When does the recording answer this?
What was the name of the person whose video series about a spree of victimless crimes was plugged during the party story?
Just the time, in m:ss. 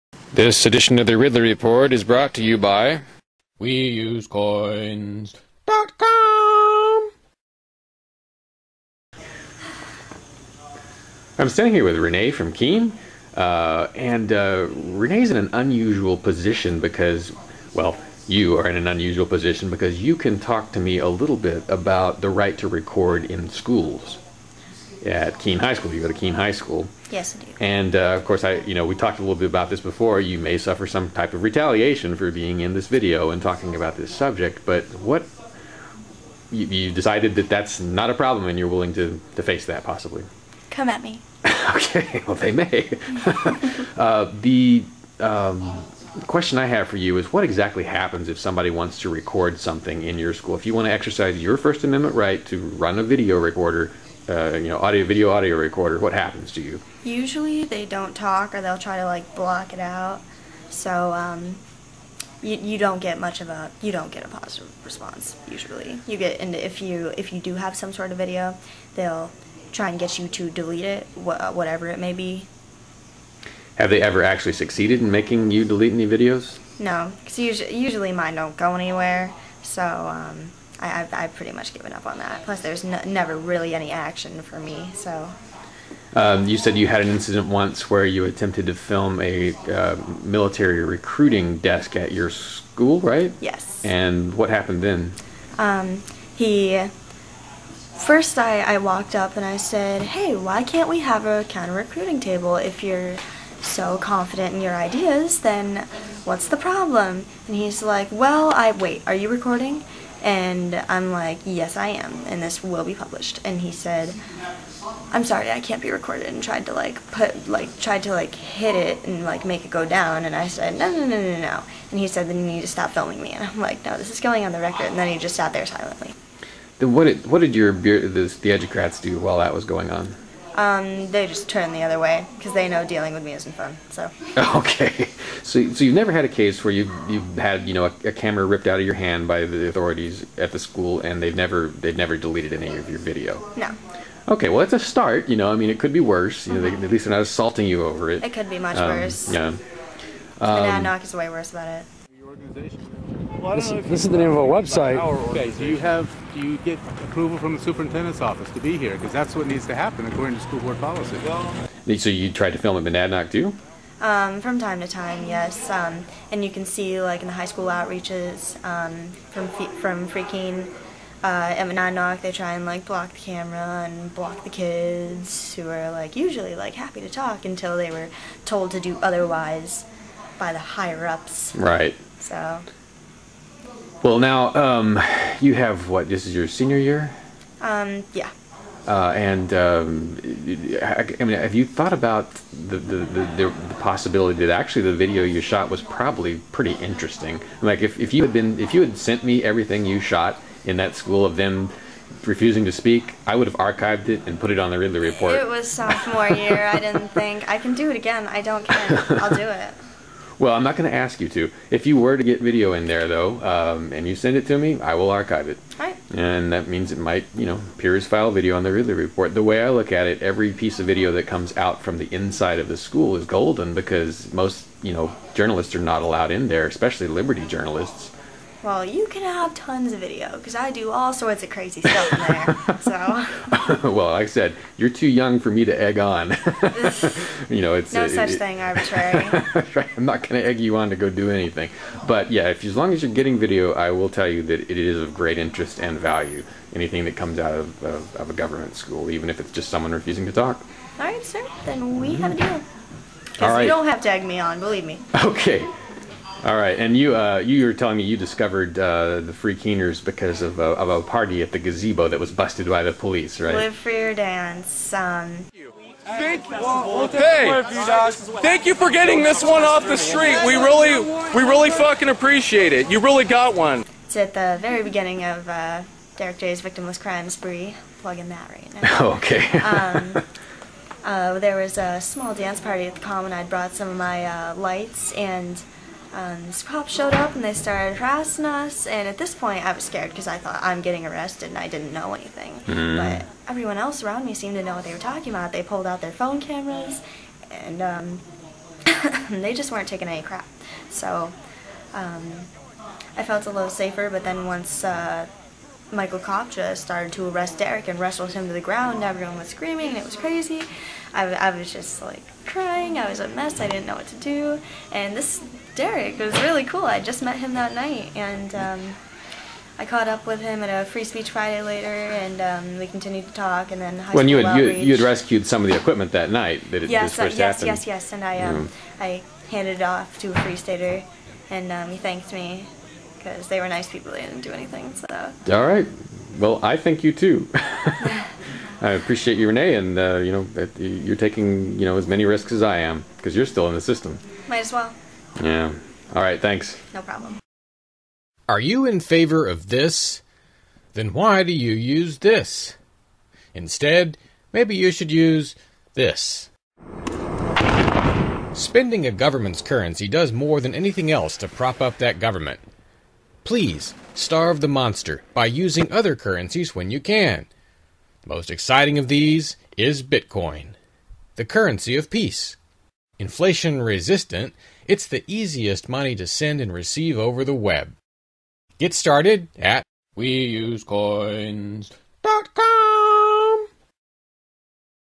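4:36.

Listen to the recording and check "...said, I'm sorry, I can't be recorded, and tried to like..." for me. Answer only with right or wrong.
right.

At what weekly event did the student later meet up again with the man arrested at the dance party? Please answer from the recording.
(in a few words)
Free Speech Friday.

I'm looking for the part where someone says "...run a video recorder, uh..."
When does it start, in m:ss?
0:52.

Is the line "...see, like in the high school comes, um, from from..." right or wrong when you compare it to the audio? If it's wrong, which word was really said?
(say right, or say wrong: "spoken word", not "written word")
wrong: "outreaches", not "comes".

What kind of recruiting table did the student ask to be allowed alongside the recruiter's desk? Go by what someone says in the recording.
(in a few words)
counter recruiting table.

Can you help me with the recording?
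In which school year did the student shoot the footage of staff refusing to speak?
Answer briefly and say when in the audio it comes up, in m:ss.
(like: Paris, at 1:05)
Sophomore year, at 3:25.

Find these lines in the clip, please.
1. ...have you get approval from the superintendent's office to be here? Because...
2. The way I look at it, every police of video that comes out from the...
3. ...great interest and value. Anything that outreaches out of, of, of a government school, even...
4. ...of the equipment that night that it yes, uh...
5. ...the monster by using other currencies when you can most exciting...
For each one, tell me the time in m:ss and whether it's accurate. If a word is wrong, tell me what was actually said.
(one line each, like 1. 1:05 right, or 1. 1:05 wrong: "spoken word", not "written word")
1. 2:35 right
2. 3:39 wrong: "piece", not "police"
3. 4:05 wrong: "comes", not "outreaches"
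4. 5:25 right
5. 6:04 right.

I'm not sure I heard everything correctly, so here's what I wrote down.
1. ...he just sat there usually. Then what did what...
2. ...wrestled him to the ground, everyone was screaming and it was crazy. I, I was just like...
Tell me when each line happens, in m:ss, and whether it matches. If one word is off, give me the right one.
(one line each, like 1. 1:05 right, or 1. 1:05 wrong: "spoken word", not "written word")
1. 2:05 wrong: "silently", not "usually"
2. 5:07 right.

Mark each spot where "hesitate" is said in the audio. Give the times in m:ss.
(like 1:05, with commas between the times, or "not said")
not said.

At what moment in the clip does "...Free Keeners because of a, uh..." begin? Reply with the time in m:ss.
4:19.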